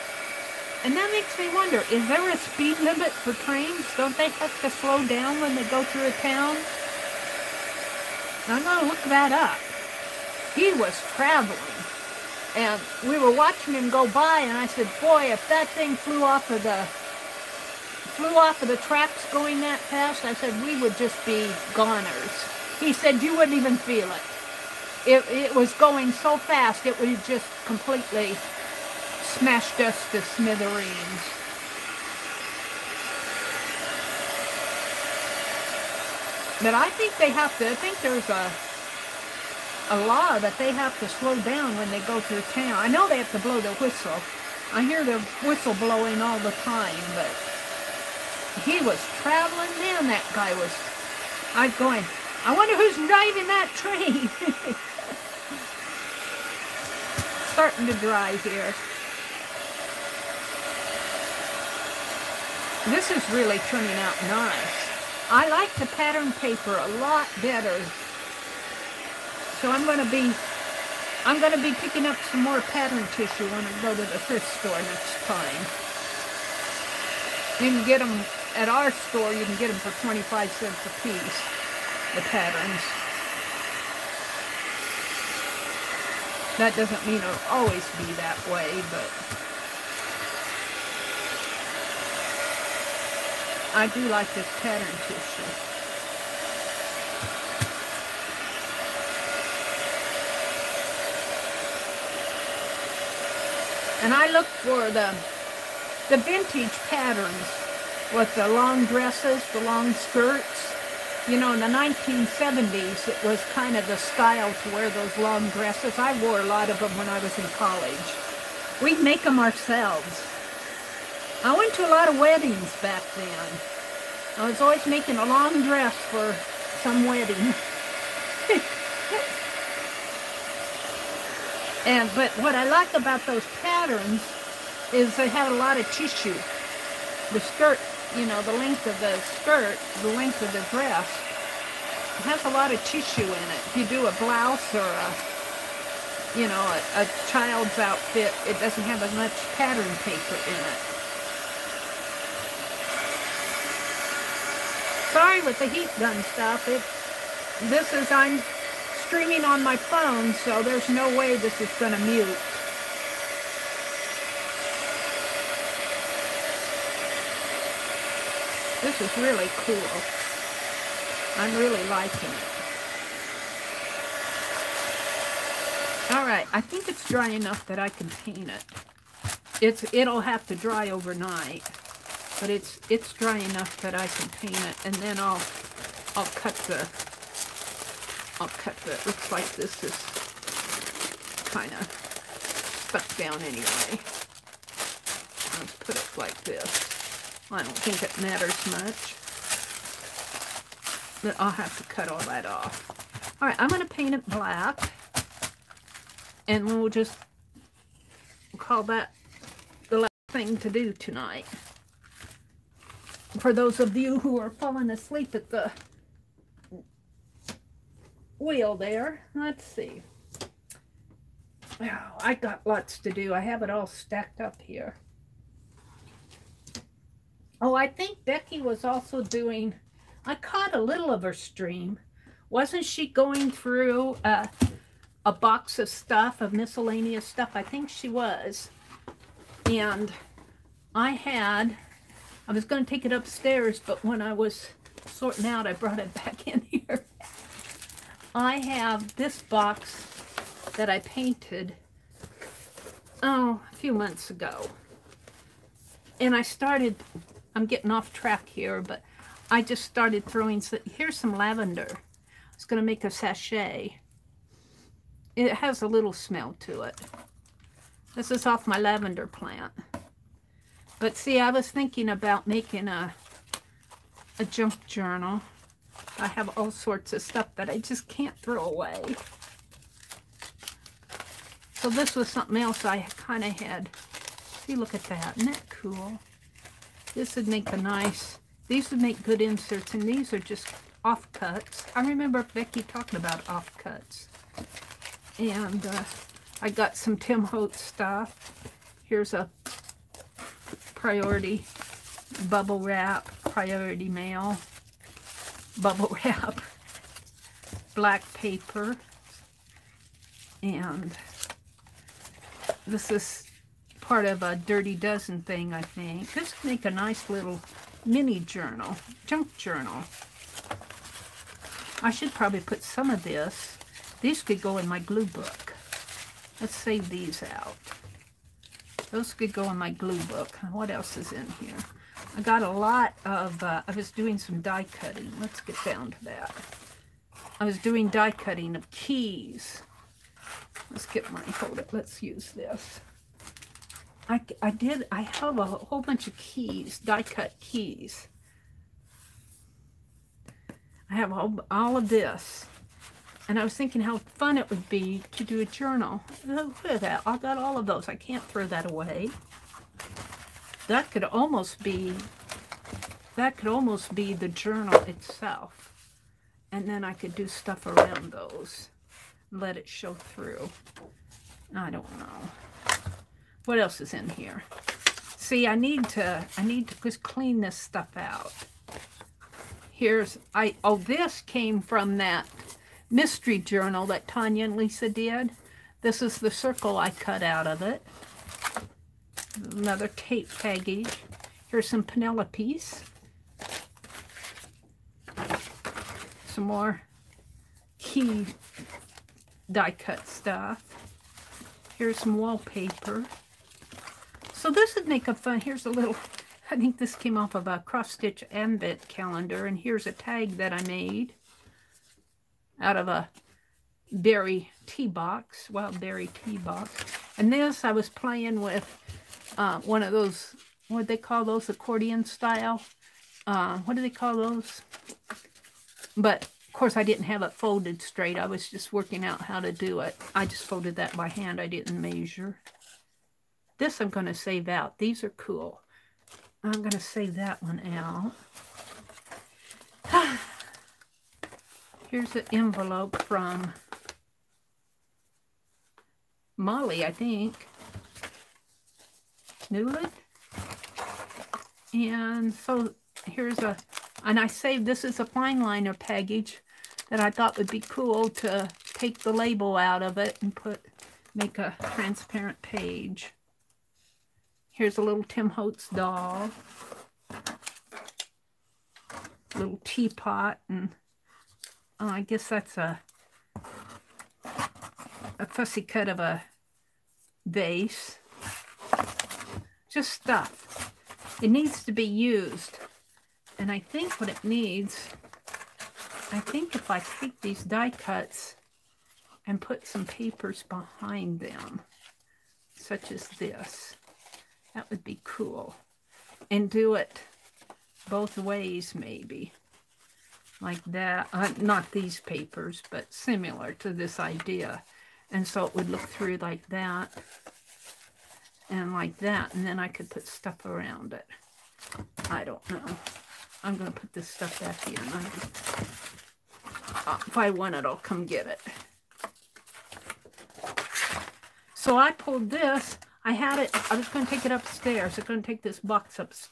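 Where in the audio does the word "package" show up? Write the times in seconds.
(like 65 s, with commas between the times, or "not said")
390 s, 455 s.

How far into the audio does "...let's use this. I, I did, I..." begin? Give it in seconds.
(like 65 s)
341 s.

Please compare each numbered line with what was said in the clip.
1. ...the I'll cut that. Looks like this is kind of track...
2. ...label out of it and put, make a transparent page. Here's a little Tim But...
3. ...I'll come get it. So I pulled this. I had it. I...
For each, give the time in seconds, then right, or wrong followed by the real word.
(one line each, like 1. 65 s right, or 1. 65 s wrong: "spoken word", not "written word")
1. 186 s wrong: "stuck", not "track"
2. 459 s wrong: "Holtz", not "But"
3. 517 s right.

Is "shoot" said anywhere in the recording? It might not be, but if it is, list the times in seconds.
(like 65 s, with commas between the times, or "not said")
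not said.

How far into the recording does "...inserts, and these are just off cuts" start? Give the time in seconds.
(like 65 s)
289 s.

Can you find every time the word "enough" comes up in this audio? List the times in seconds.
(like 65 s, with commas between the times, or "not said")
177 s, 183 s.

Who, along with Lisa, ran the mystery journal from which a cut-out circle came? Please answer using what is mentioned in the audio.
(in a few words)
Tanya.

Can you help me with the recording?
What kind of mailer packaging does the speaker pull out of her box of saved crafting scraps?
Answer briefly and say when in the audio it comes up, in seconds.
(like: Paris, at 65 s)
Priority mail bubble wrap, at 303 s.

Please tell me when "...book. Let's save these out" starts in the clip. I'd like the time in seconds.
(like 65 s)
325 s.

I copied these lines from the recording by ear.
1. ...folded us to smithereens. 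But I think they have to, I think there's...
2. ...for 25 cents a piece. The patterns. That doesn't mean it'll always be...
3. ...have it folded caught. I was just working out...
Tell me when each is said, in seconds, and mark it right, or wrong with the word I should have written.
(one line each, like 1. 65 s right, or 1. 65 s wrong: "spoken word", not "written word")
1. 29 s wrong: "smashed", not "folded"
2. 79 s right
3. 427 s wrong: "straight", not "caught".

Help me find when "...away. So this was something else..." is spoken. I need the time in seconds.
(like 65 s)
278 s.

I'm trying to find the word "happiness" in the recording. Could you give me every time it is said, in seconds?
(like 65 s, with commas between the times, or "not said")
not said.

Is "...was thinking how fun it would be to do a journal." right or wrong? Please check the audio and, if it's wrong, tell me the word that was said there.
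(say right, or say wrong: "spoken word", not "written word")
right.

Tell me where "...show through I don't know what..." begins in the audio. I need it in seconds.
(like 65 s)
369 s.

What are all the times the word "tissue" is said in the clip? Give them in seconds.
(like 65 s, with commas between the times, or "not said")
73 s, 95 s, 135 s, 142 s.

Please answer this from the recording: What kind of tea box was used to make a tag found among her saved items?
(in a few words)
Wild berry tea.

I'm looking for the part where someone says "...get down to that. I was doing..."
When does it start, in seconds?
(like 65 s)
335 s.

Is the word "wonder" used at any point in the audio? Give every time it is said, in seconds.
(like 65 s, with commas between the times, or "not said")
1 s, 52 s.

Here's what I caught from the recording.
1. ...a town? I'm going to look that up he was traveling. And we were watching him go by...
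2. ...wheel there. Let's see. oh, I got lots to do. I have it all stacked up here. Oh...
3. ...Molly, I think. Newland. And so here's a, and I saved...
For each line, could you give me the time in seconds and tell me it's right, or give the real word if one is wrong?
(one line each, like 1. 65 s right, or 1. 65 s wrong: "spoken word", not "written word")
1. 6 s right
2. 218 s right
3. 446 s right.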